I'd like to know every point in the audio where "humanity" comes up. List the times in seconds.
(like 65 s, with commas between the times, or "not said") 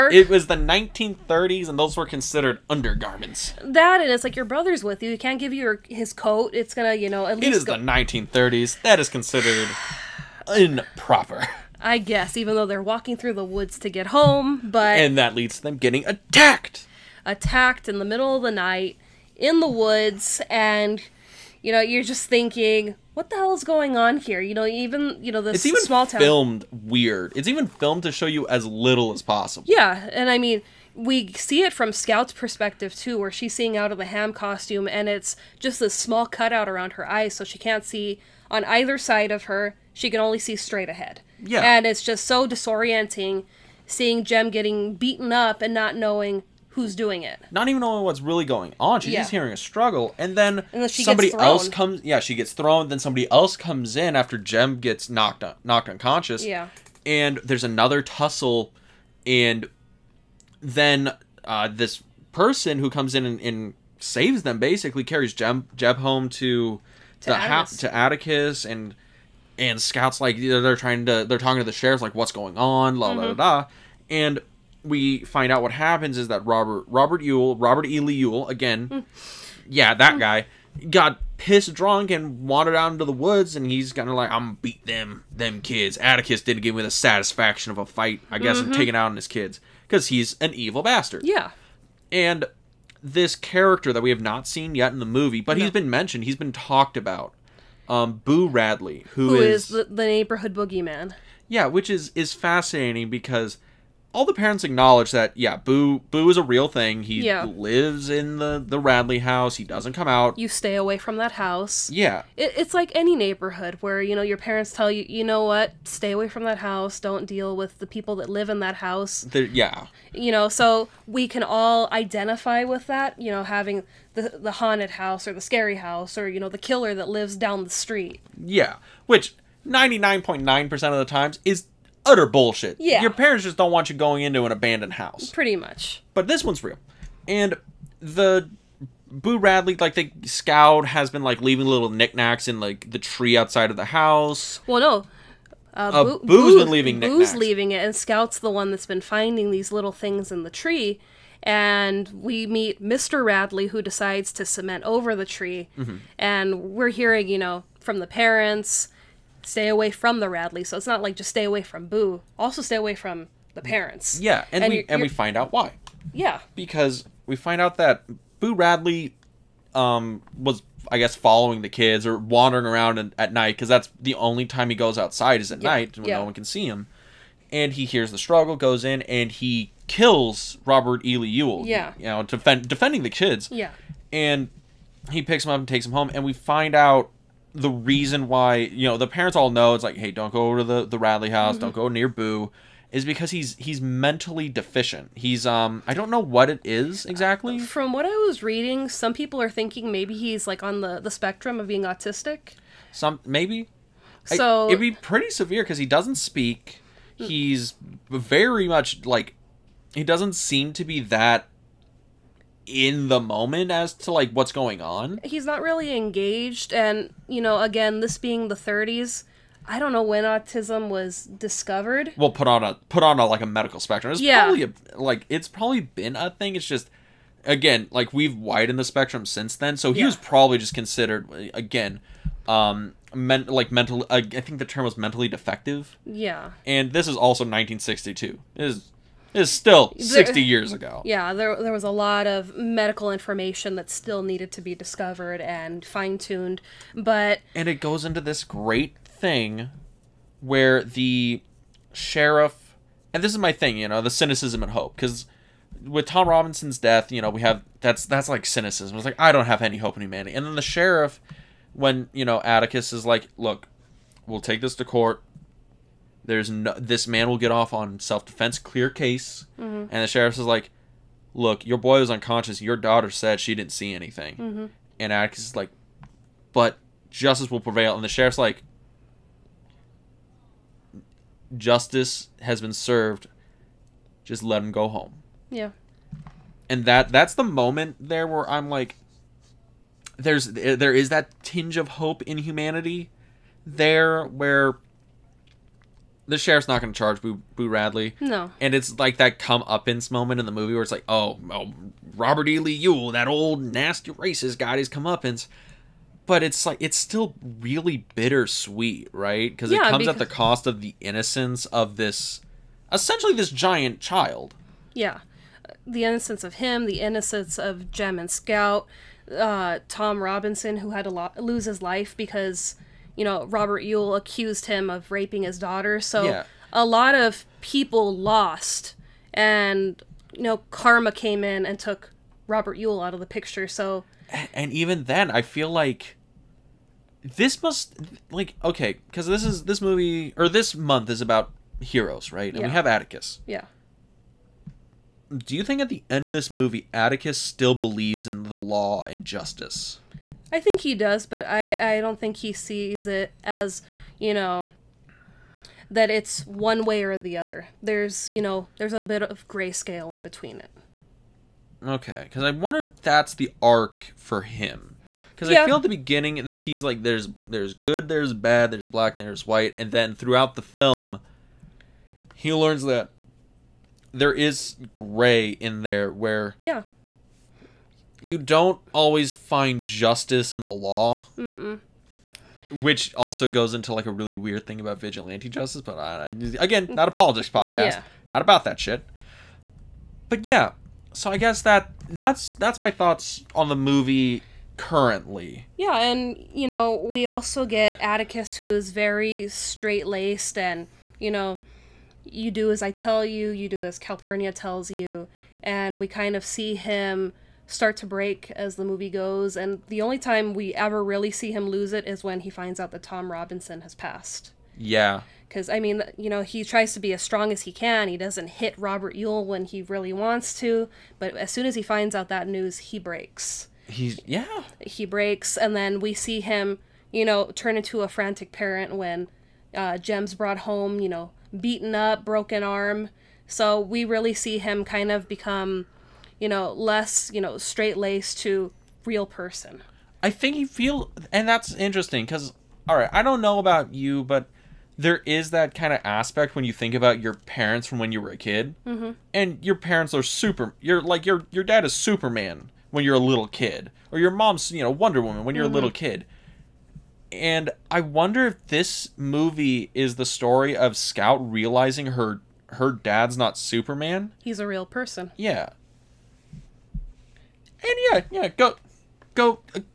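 260 s, 292 s.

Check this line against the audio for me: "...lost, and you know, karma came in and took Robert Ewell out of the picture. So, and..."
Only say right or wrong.
right.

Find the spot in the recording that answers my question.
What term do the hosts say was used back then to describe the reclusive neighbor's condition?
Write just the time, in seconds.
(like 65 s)
234 s.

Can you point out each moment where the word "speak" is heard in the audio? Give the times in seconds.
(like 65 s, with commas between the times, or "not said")
206 s.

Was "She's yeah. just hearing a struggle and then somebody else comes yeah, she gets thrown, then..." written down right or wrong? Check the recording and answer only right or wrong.
right.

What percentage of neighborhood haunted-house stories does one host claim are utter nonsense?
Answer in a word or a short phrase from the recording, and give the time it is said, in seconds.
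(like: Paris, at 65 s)
99.9%, at 129 s.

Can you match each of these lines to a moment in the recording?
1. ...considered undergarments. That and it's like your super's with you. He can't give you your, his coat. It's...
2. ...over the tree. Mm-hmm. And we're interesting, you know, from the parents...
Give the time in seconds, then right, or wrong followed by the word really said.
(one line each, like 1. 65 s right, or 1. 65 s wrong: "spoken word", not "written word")
1. 2 s wrong: "brother", not "super"
2. 154 s wrong: "hearing", not "interesting".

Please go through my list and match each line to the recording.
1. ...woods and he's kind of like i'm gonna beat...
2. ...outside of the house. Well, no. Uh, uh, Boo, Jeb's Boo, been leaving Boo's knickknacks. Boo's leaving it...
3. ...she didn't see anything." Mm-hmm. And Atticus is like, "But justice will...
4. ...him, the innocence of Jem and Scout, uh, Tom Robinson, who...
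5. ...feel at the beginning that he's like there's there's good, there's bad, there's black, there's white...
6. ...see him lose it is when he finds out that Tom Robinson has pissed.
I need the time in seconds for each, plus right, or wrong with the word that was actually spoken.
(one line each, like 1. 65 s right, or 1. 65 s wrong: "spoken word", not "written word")
1. 83 s right
2. 143 s wrong: "Boo", not "Jeb"
3. 273 s right
4. 316 s right
5. 365 s right
6. 411 s wrong: "passed", not "pissed".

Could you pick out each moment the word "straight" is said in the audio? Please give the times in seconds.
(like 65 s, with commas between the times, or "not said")
40 s, 399 s, 437 s.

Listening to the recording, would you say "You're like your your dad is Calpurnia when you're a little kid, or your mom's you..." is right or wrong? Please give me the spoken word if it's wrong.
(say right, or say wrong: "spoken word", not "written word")
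wrong: "Superman", not "Calpurnia".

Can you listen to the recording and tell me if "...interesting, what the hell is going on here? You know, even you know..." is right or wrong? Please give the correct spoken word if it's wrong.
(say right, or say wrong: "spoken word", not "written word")
wrong: "thinking", not "interesting".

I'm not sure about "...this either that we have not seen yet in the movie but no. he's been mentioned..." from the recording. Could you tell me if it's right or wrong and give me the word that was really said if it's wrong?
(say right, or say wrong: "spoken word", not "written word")
wrong: "character", not "either".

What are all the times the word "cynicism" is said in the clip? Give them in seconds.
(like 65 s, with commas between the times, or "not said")
254 s, 258 s.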